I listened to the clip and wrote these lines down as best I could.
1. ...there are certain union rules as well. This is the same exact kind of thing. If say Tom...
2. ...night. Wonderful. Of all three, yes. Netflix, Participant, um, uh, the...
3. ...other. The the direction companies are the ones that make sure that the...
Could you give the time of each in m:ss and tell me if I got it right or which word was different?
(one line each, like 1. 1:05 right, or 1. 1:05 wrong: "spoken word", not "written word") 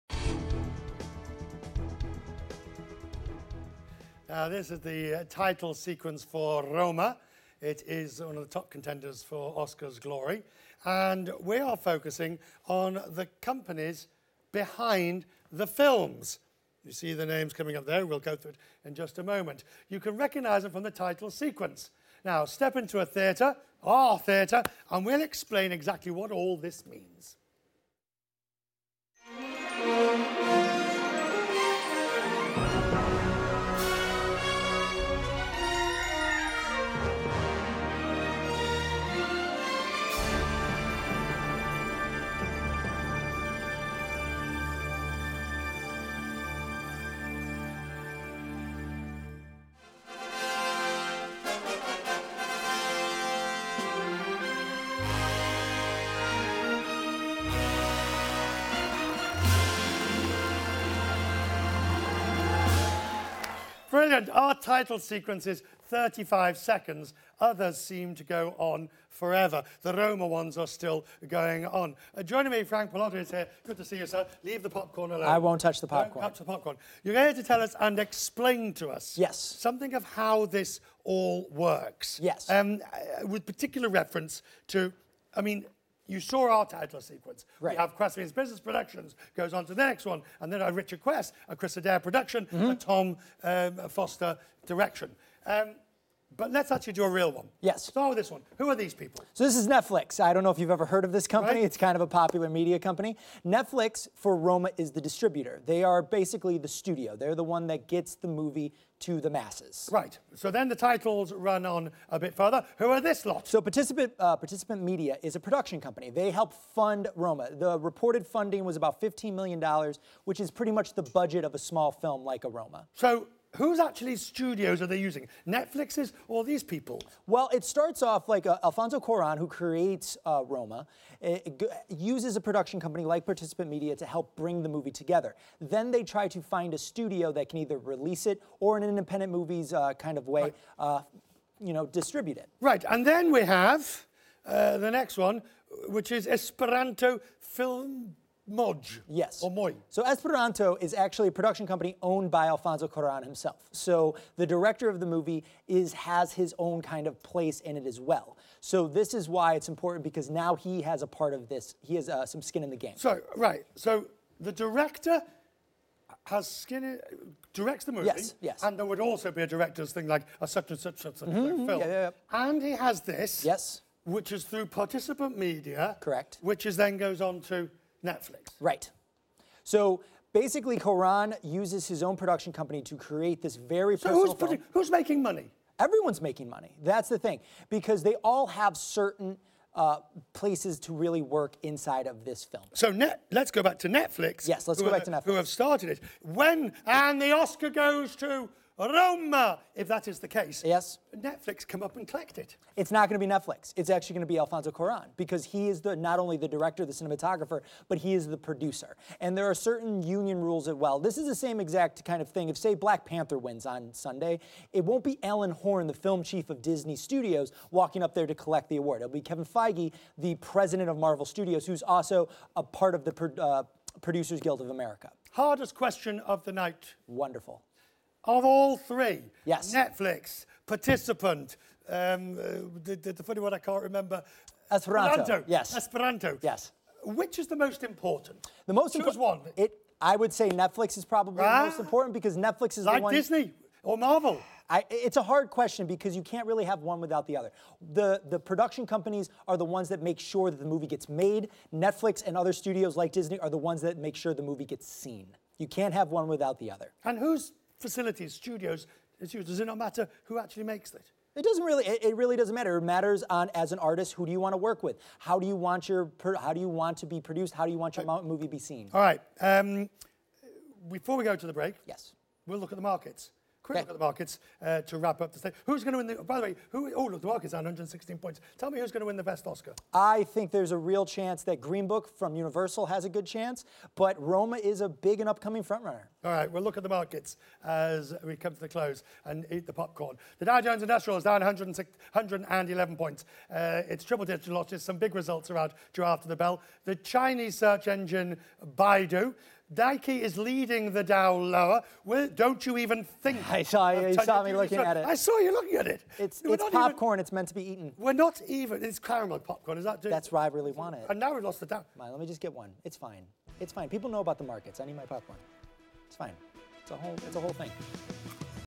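1. 3:29 wrong: "Black", not "Tom"
2. 3:46 right
3. 4:07 wrong: "production", not "direction".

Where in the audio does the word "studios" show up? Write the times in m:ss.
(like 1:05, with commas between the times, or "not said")
1:46, 2:04, 2:16, 3:36, 3:41, 4:12, 4:18.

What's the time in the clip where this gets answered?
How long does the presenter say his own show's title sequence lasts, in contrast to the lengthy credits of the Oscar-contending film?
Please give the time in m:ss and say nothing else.
1:05.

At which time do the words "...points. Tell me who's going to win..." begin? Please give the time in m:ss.
4:38.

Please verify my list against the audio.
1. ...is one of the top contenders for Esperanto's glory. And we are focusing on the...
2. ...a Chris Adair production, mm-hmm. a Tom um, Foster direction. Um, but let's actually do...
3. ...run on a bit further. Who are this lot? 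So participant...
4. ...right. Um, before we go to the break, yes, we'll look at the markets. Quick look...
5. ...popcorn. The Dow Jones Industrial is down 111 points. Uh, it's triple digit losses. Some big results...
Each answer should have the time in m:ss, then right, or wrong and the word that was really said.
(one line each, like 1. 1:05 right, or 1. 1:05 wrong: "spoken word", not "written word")
1. 0:07 wrong: "Oscar", not "Esperanto"
2. 1:31 right
3. 1:51 right
4. 4:28 right
5. 4:49 right.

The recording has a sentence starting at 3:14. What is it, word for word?
Yes, let's go back to Netflix.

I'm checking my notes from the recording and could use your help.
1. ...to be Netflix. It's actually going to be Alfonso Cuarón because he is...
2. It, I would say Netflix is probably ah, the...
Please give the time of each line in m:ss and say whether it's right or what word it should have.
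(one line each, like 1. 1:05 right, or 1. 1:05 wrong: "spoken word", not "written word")
1. 3:23 right
2. 3:59 right.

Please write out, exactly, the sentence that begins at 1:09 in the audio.
The Roma ones are still going on.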